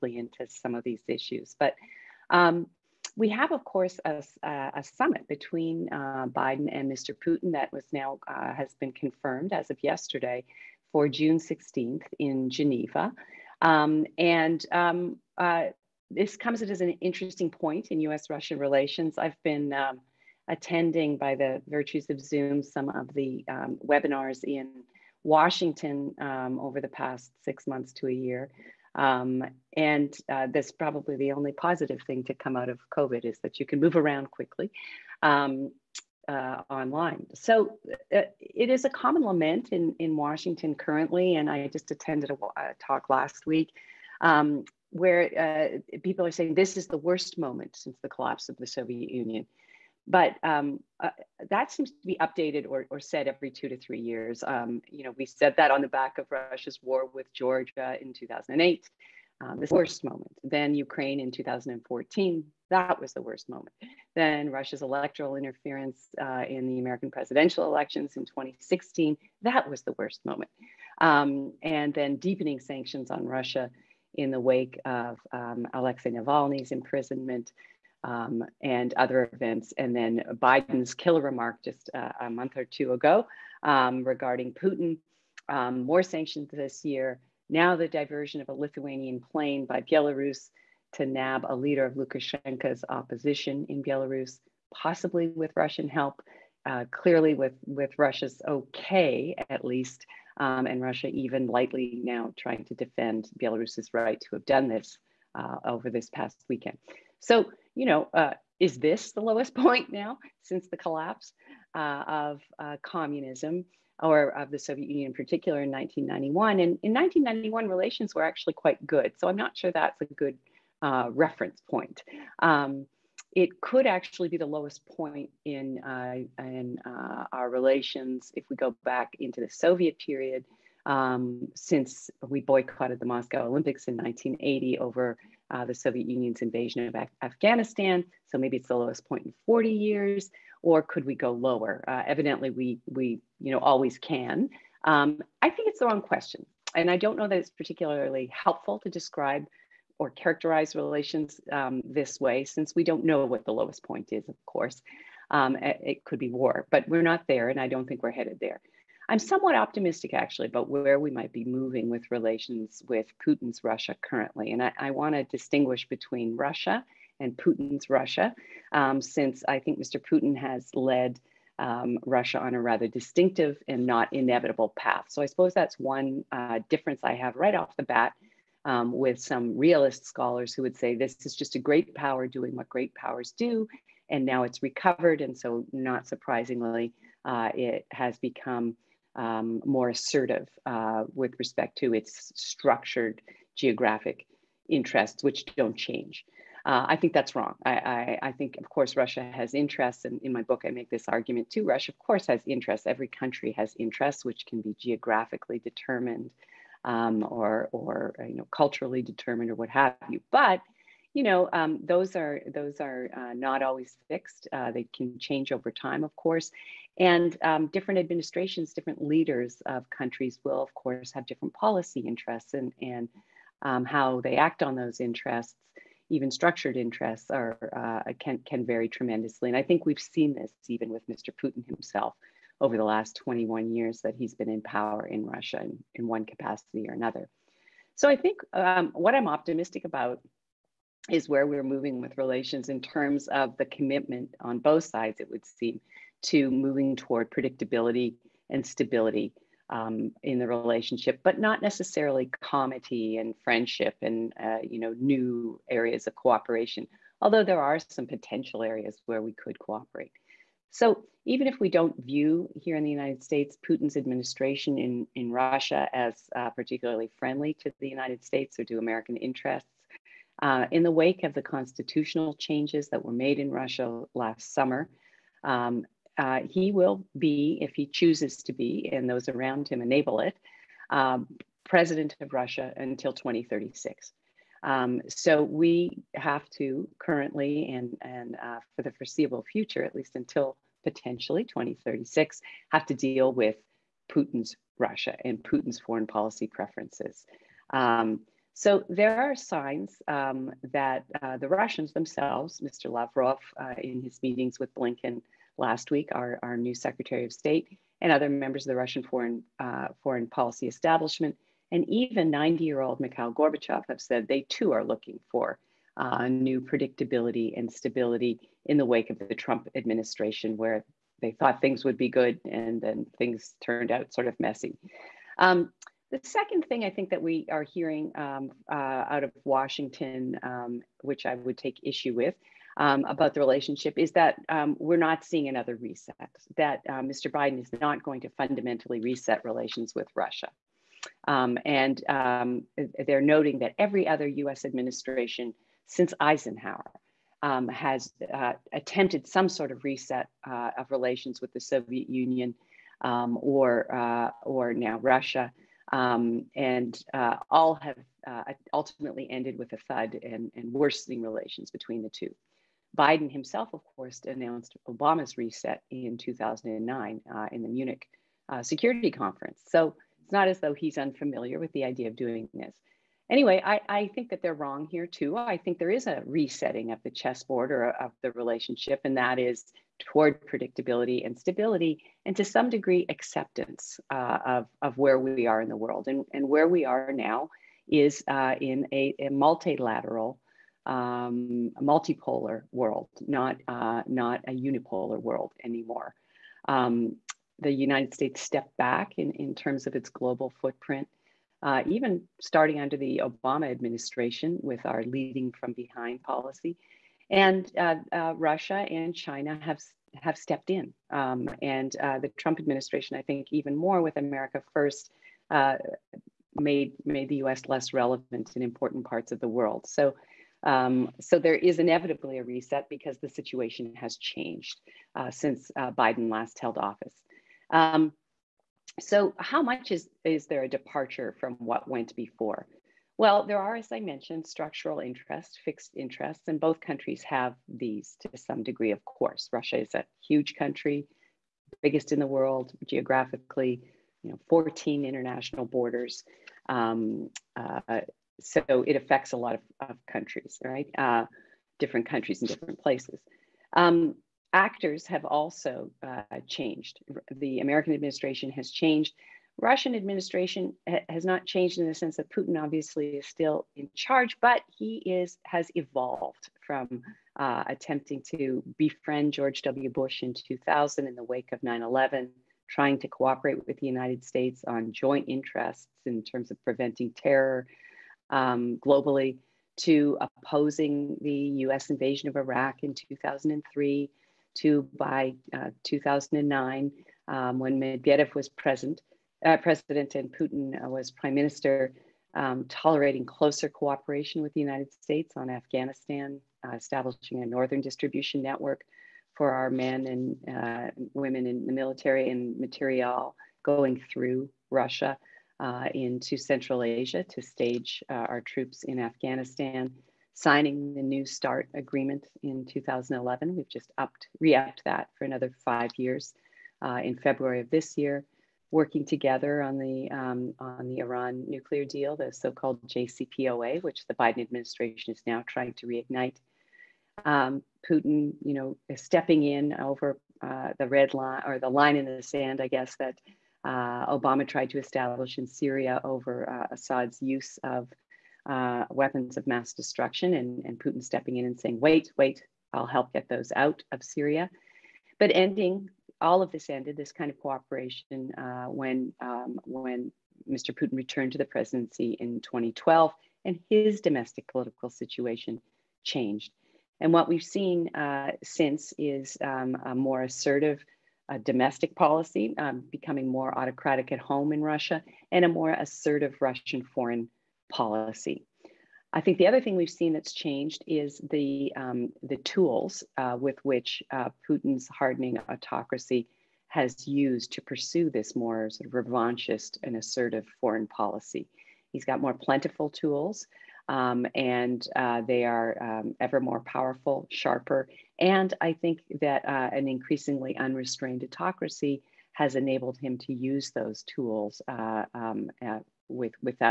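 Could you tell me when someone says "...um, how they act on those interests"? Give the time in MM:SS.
03:43.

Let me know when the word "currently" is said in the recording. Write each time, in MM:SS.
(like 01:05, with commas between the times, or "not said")
00:40, 02:44, 04:46.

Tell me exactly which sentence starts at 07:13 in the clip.
Well, there are, as I mentioned, structural interests, fixed interests, and both countries have these to some degree, of course.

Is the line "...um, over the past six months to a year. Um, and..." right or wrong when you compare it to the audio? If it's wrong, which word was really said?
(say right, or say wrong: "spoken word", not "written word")
right.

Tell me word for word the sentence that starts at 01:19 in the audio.
And then Biden's killer remark just uh, a month or two ago um, regarding Putin, um, more sanctions this year.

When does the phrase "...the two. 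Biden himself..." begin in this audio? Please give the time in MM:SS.
06:02.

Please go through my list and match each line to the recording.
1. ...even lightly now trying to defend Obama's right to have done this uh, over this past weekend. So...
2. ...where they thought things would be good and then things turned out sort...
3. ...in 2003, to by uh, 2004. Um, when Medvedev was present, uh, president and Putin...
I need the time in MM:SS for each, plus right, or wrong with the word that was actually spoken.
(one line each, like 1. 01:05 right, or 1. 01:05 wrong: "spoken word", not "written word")
1. 01:41 wrong: "Belarus", not "Obama"
2. 05:20 right
3. 08:02 wrong: "2009", not "2004".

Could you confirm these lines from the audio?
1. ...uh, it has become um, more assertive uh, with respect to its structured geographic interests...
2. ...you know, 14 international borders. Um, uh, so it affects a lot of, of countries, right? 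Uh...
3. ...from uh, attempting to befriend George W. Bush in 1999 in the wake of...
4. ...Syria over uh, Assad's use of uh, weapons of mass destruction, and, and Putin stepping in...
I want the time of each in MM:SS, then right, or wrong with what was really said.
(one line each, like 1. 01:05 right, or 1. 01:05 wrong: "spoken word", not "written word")
1. 03:07 right
2. 07:24 right
3. 07:46 wrong: "2000", not "1999"
4. 08:55 right.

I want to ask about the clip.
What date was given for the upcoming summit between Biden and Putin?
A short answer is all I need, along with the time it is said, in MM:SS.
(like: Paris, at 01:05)
June 16th, at 00:11.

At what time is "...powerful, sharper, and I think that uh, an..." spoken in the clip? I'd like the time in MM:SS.
09:46.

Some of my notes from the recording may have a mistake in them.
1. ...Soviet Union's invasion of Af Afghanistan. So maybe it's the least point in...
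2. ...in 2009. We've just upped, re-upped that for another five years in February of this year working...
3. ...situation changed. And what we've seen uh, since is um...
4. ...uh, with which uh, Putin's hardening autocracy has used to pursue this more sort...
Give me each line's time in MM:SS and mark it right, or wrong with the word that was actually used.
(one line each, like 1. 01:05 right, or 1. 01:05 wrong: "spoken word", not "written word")
1. 02:15 wrong: "lowest", not "least"
2. 08:32 wrong: "2011", not "2009"
3. 09:14 right
4. 09:33 right.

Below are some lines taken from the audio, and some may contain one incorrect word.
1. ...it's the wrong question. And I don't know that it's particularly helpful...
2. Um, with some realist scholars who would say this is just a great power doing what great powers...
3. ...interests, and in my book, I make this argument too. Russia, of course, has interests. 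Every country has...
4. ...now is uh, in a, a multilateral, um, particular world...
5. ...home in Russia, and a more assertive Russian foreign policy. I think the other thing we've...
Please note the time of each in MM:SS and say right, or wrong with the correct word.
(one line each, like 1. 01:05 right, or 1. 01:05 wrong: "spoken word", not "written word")
1. 02:25 right
2. 02:58 right
3. 03:19 right
4. 06:27 wrong: "multipolar", not "particular"
5. 09:24 right.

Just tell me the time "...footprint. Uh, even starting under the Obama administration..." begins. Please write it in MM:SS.
06:40.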